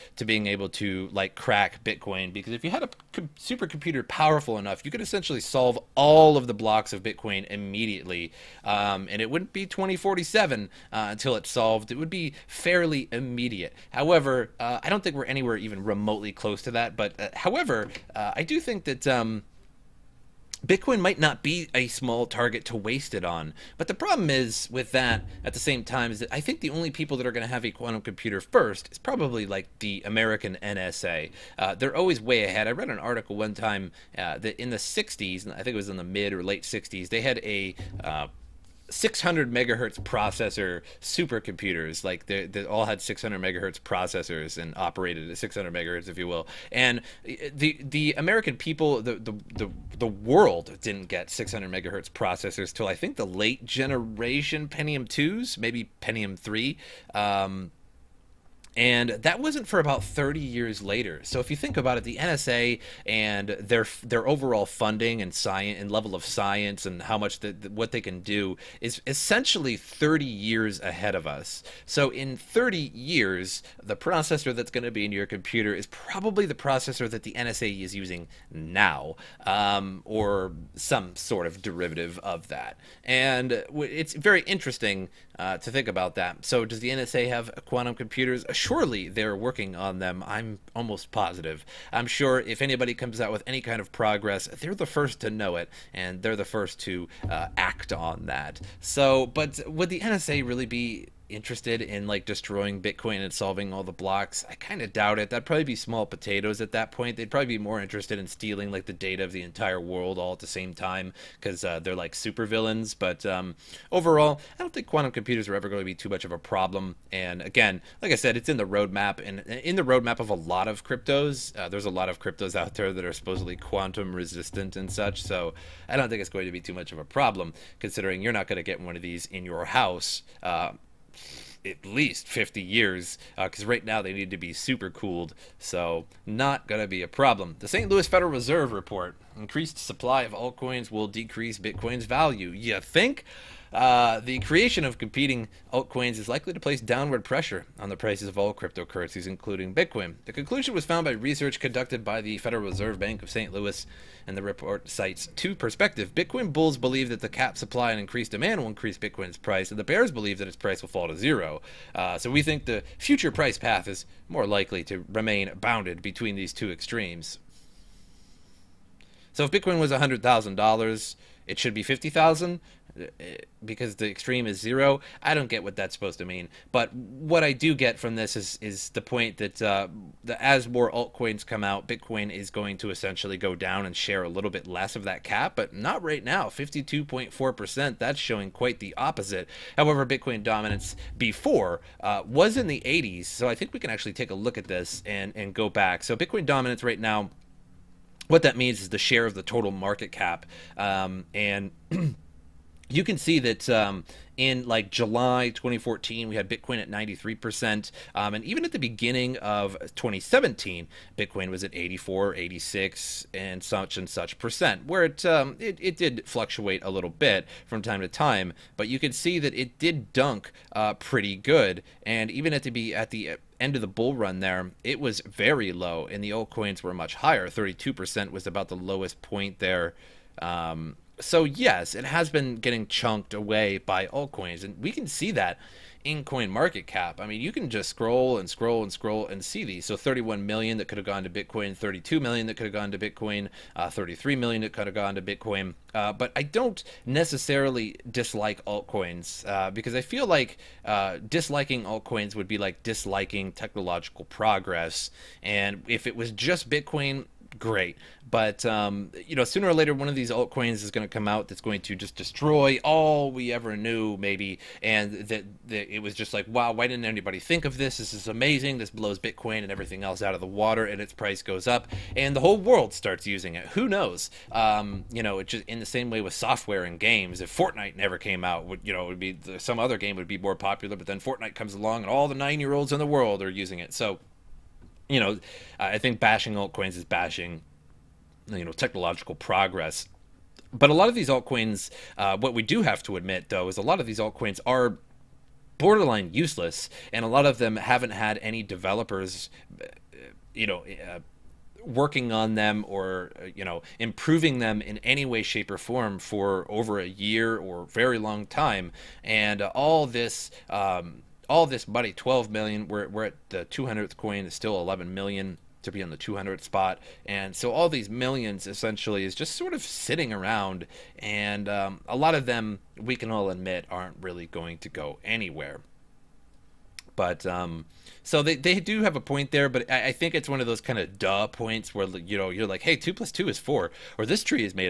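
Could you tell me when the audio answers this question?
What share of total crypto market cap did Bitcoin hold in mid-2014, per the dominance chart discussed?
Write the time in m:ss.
3:26.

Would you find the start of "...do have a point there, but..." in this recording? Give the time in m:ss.
5:28.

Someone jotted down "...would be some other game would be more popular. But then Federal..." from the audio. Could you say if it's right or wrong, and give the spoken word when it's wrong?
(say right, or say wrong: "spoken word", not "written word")
wrong: "Fortnite", not "Federal".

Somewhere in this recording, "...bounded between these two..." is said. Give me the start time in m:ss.
2:45.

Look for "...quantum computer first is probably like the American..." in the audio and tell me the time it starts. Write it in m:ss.
0:27.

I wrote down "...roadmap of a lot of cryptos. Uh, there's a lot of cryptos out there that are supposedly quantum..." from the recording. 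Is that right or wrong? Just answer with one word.
right.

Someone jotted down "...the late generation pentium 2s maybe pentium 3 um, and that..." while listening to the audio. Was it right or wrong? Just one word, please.
right.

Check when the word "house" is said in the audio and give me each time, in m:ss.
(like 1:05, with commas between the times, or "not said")
2:09.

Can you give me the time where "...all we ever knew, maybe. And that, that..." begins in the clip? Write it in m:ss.
4:22.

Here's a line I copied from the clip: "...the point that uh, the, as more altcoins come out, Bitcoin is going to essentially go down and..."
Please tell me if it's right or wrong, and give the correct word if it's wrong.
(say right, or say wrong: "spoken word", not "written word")
right.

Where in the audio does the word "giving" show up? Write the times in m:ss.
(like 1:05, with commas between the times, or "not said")
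not said.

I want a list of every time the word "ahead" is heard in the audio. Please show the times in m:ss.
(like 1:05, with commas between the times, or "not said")
0:32, 1:10.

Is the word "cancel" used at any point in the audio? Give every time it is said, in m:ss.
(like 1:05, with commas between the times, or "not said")
not said.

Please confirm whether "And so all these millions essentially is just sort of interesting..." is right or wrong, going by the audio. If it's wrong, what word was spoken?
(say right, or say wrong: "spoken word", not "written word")
wrong: "sitting", not "interesting".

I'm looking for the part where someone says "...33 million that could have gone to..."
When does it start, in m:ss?
4:03.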